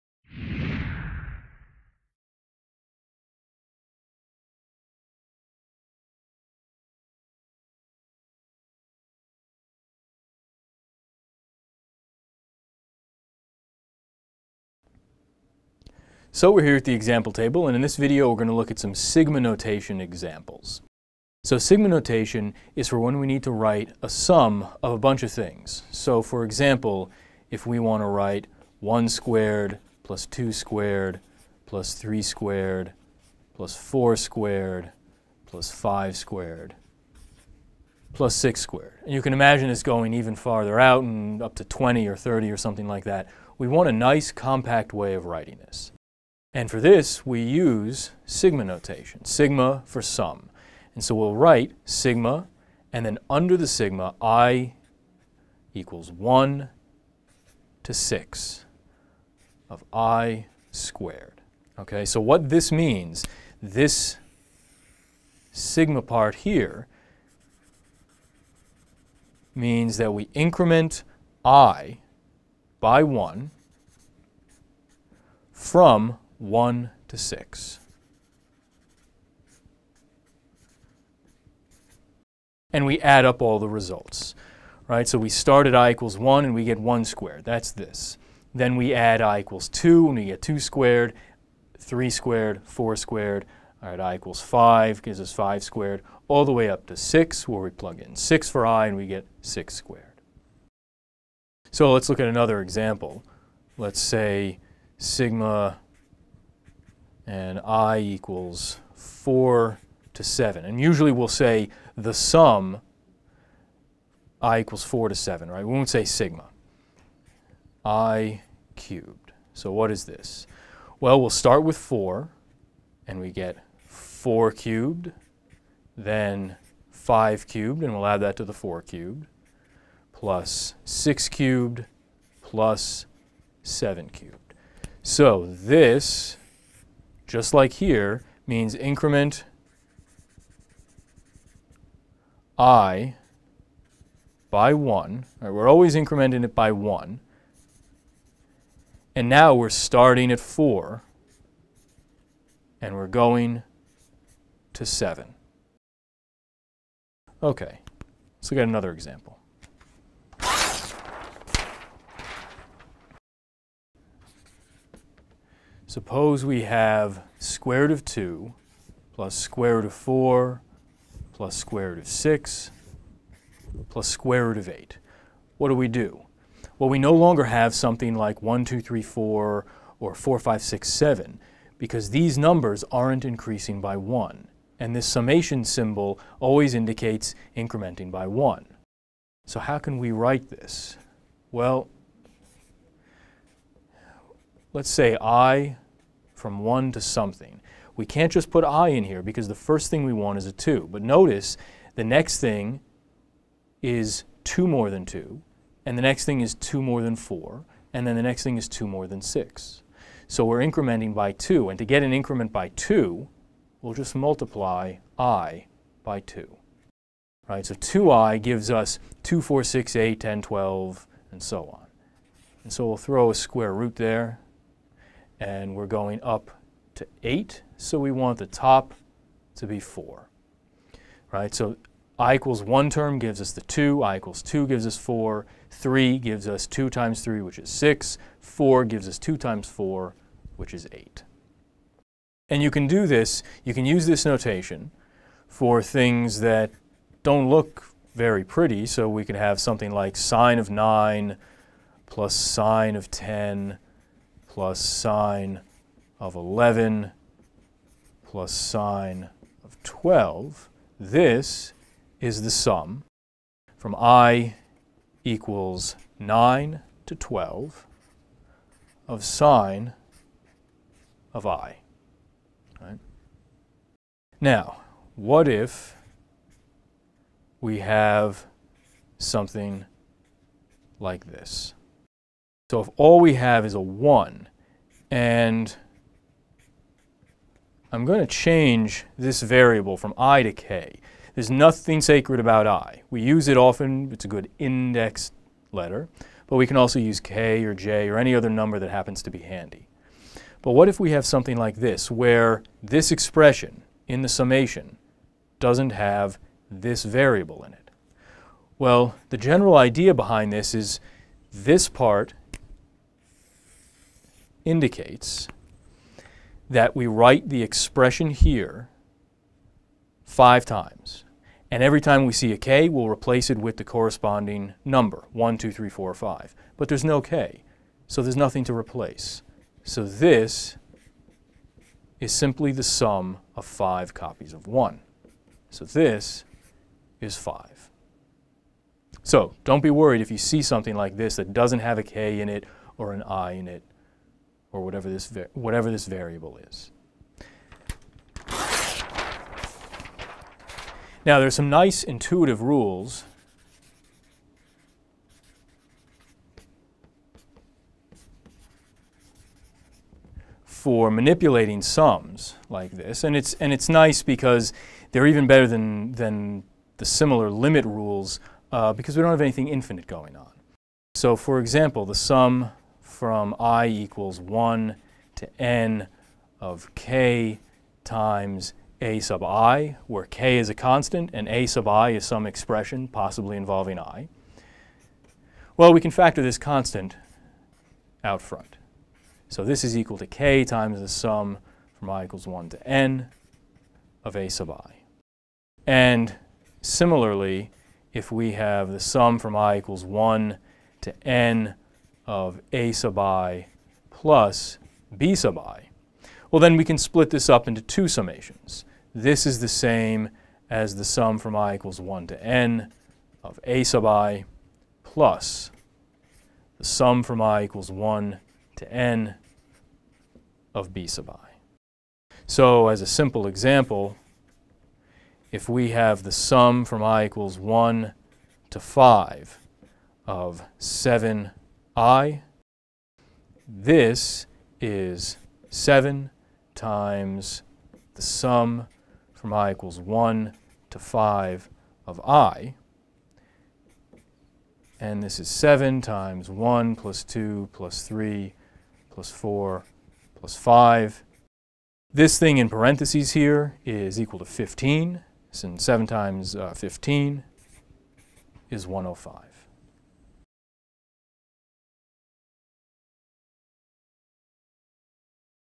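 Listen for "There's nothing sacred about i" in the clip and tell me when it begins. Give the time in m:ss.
4:51.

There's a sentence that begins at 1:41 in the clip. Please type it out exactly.
So let's look at another example.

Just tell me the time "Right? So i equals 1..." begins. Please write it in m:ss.
3:51.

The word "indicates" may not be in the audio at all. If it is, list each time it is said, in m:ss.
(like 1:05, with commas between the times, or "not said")
3:06, 5:14.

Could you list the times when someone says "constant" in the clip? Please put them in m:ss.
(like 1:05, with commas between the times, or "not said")
6:20, 6:26.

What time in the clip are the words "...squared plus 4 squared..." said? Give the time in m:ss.
0:32.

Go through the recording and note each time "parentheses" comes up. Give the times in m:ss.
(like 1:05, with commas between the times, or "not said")
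7:32.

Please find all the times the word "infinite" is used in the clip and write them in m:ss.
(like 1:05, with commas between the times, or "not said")
6:09.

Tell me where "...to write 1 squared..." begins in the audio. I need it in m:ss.
0:28.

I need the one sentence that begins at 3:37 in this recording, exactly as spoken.
Right, so 2i gives us 2, 4, 6, 8, 10, 12, and so on.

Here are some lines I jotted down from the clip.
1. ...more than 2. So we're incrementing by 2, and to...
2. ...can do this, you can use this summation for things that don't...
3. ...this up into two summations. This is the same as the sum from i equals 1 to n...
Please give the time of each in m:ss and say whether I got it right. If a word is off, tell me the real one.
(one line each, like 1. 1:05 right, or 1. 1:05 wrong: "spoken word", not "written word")
1. 3:28 wrong: "6", not "2"
2. 4:02 wrong: "notation", not "summation"
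3. 6:47 right.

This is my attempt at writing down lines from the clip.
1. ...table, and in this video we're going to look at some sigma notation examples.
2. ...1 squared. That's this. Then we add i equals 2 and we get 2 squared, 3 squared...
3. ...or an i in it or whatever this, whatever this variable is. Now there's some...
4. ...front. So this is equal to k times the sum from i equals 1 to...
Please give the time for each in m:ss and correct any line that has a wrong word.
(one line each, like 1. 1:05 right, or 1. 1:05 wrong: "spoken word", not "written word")
1. 0:17 right
2. 1:26 right
3. 5:42 right
4. 6:28 right.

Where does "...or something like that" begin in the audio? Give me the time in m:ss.
0:42.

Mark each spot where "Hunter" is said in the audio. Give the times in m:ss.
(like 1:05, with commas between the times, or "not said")
not said.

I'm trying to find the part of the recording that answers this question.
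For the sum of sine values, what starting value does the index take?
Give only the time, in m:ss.
4:23.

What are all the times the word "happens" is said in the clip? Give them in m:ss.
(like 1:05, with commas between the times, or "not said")
4:58.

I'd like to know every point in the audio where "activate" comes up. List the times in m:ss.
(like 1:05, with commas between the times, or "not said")
not said.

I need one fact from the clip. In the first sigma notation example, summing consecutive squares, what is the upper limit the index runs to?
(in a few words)
6.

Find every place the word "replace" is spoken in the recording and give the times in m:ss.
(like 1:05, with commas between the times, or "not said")
5:23, 5:28.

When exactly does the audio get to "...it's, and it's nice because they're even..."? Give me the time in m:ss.
6:03.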